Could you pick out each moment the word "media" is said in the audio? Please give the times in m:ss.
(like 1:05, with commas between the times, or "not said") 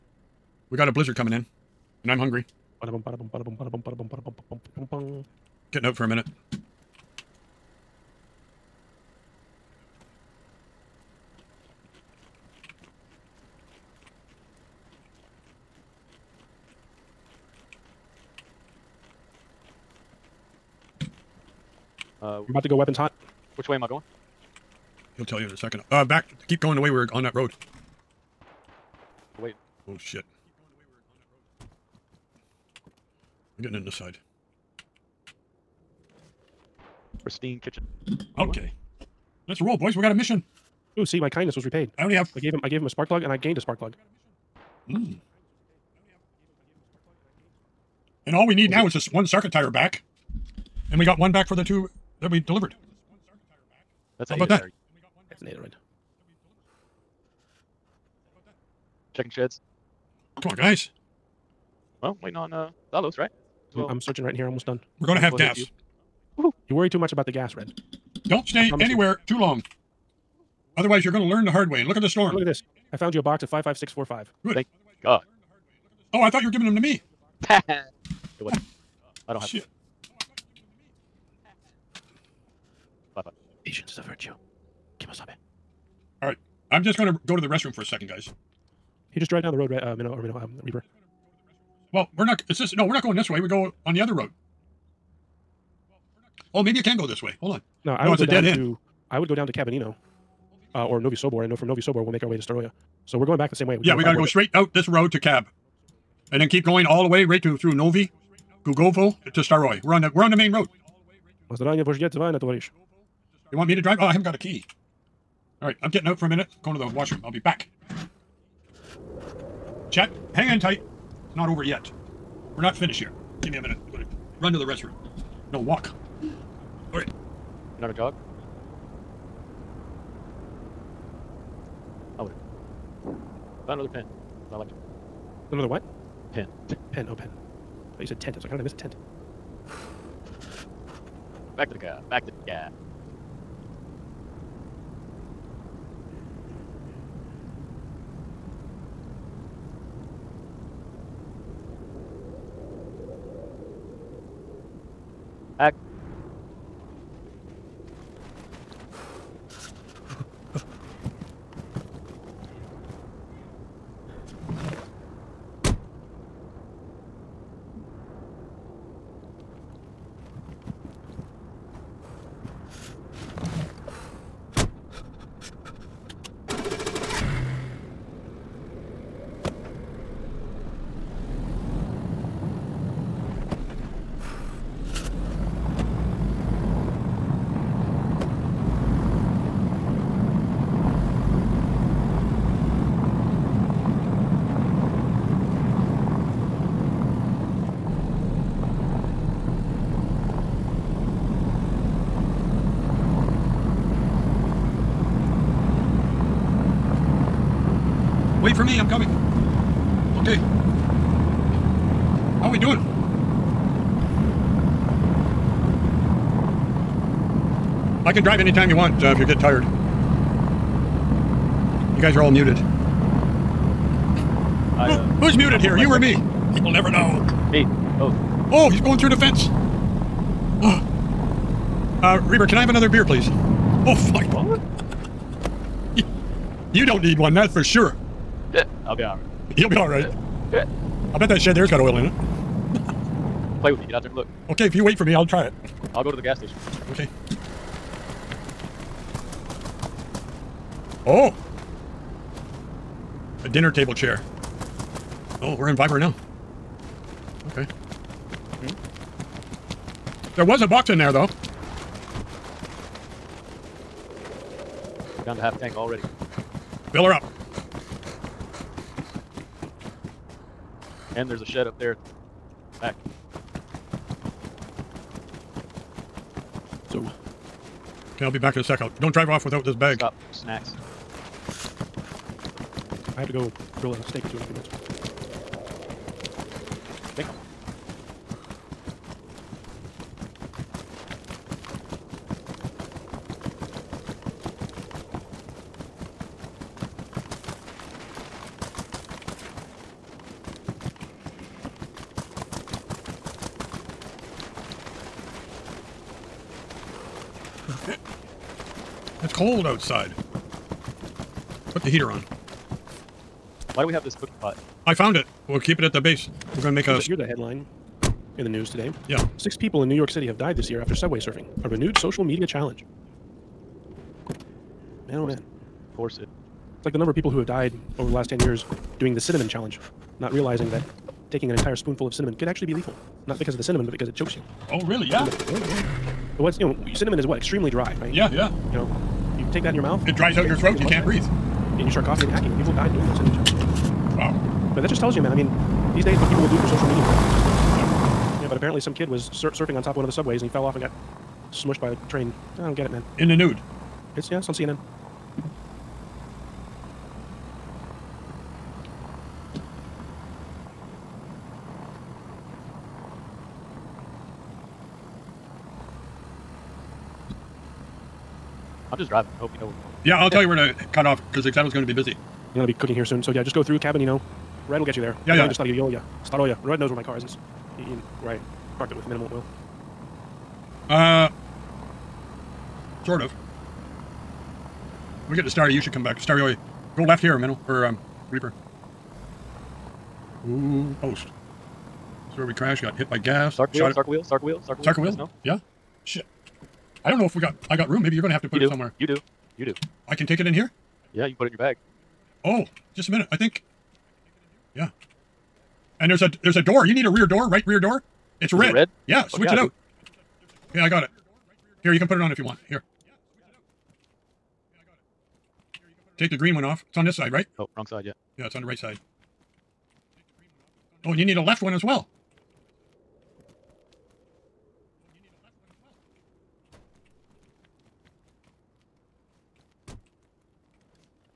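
5:22, 5:46.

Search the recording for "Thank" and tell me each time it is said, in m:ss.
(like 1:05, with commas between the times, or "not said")
1:14.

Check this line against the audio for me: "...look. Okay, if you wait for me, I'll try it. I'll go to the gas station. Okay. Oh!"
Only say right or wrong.
right.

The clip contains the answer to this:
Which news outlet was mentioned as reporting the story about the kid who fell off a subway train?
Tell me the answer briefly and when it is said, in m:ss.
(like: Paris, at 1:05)
CNN, at 5:54.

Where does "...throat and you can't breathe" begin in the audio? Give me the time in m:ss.
5:40.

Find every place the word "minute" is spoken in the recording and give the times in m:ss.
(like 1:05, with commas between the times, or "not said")
0:06, 1:56, 2:03, 4:44, 6:43.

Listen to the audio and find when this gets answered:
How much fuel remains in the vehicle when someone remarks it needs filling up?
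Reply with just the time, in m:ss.
4:25.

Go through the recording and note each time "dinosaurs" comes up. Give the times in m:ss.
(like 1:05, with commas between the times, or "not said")
not said.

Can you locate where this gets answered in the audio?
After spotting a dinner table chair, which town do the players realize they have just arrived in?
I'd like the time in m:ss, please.
4:15.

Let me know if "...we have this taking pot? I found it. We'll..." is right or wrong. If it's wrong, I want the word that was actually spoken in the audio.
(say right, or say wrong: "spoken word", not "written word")
wrong: "cooking", not "taking".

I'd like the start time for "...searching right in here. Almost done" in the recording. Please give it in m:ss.
1:03.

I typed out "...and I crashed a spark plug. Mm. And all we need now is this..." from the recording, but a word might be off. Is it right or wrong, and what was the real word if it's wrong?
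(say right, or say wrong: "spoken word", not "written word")
wrong: "gained", not "crashed".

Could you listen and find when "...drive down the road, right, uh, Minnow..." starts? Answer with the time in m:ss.
1:29.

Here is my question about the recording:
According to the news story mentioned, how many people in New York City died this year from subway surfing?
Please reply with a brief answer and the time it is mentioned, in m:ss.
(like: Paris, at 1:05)
6, at 5:19.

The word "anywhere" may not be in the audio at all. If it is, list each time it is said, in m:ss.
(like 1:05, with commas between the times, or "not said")
1:08.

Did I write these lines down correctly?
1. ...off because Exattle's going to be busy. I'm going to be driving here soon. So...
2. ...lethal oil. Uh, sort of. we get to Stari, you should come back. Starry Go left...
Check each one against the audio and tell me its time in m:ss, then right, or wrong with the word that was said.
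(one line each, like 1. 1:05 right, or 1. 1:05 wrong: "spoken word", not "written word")
1. 6:11 wrong: "cooking", not "driving"
2. 6:19 wrong: "minimal", not "lethal".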